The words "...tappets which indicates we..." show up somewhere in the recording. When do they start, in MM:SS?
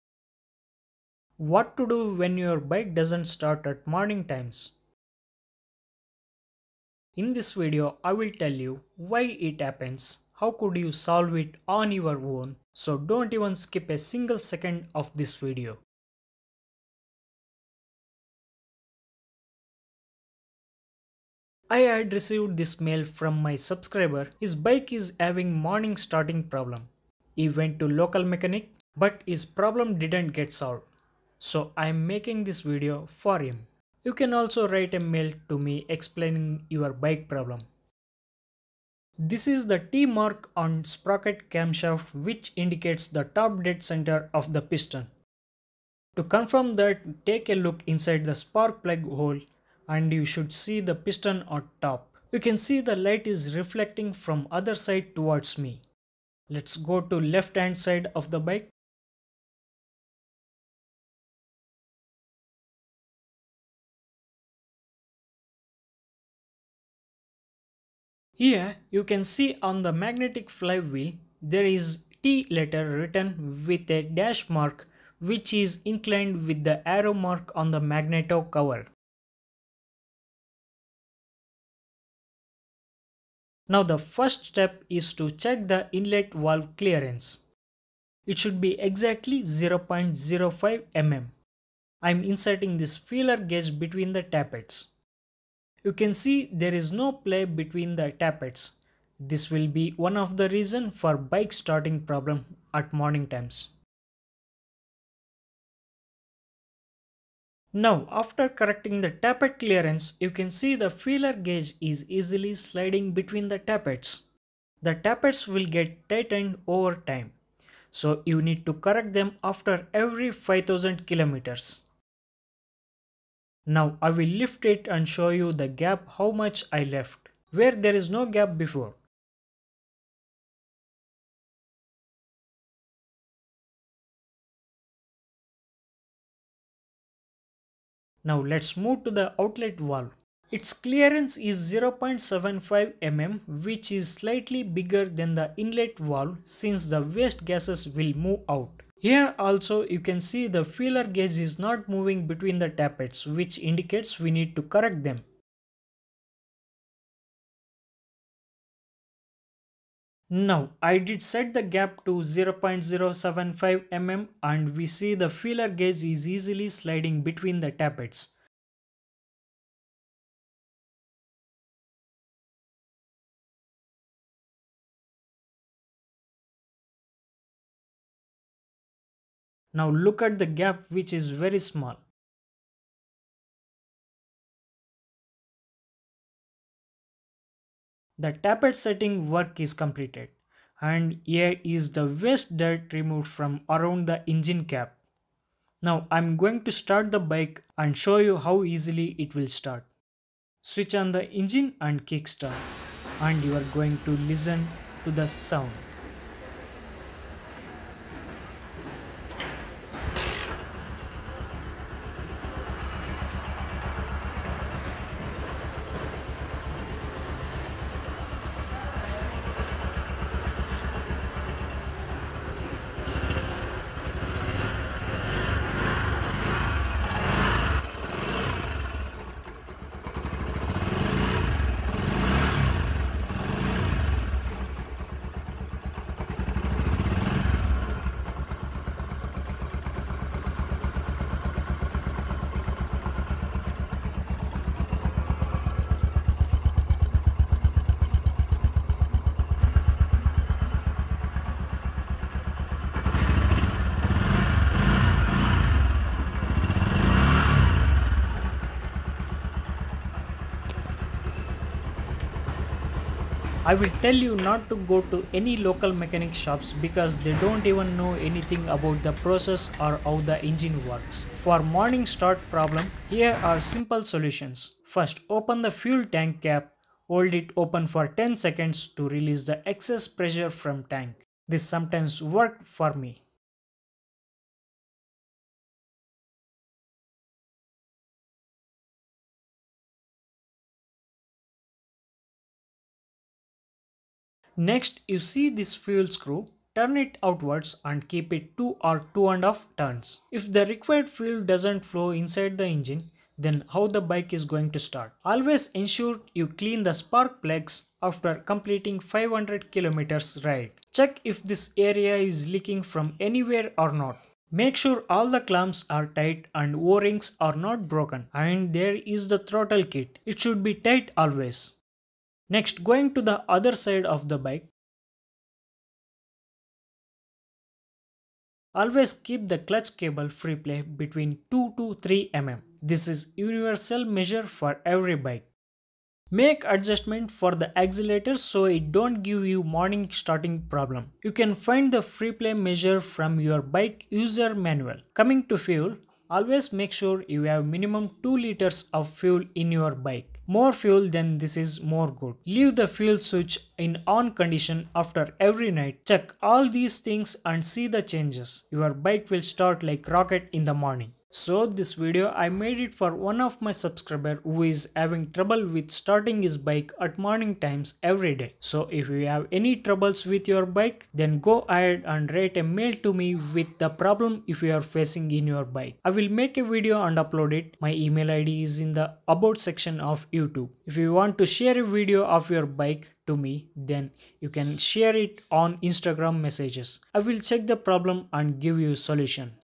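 02:32.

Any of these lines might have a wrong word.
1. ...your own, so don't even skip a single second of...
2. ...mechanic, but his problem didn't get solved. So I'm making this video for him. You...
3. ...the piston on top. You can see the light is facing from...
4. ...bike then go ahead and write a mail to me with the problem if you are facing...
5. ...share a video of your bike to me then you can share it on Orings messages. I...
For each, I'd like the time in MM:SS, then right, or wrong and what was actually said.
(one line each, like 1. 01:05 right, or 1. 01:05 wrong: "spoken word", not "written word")
1. 00:11 right
2. 00:28 right
3. 00:50 wrong: "reflecting", not "facing"
4. 06:10 right
5. 06:21 wrong: "Instagram", not "Orings".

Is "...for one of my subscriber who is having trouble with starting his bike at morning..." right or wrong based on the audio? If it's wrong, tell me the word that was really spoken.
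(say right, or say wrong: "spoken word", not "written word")
right.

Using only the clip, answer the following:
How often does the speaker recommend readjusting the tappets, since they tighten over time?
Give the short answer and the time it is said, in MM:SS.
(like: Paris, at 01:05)
every 5000 kilometers, at 02:00.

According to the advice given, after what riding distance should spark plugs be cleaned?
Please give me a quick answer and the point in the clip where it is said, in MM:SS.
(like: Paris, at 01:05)
500 kilometers, at 05:08.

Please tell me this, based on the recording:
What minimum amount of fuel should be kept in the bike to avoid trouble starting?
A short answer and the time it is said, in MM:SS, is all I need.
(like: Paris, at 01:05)
2 liters, at 05:48.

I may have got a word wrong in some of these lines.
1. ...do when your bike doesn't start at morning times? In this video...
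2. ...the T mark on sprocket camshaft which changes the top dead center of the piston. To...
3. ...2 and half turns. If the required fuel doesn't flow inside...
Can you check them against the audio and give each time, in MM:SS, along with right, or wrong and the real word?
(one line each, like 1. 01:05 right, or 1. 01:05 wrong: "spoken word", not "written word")
1. 00:01 right
2. 00:39 wrong: "indicates", not "changes"
3. 04:59 right.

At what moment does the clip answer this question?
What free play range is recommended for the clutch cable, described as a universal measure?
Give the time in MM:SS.
05:31.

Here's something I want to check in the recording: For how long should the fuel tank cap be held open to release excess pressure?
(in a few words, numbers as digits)
10 seconds.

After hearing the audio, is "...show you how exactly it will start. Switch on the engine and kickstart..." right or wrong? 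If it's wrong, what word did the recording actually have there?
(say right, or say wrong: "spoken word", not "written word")
wrong: "easily", not "exactly".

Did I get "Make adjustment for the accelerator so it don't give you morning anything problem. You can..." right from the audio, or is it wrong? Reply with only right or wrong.
wrong.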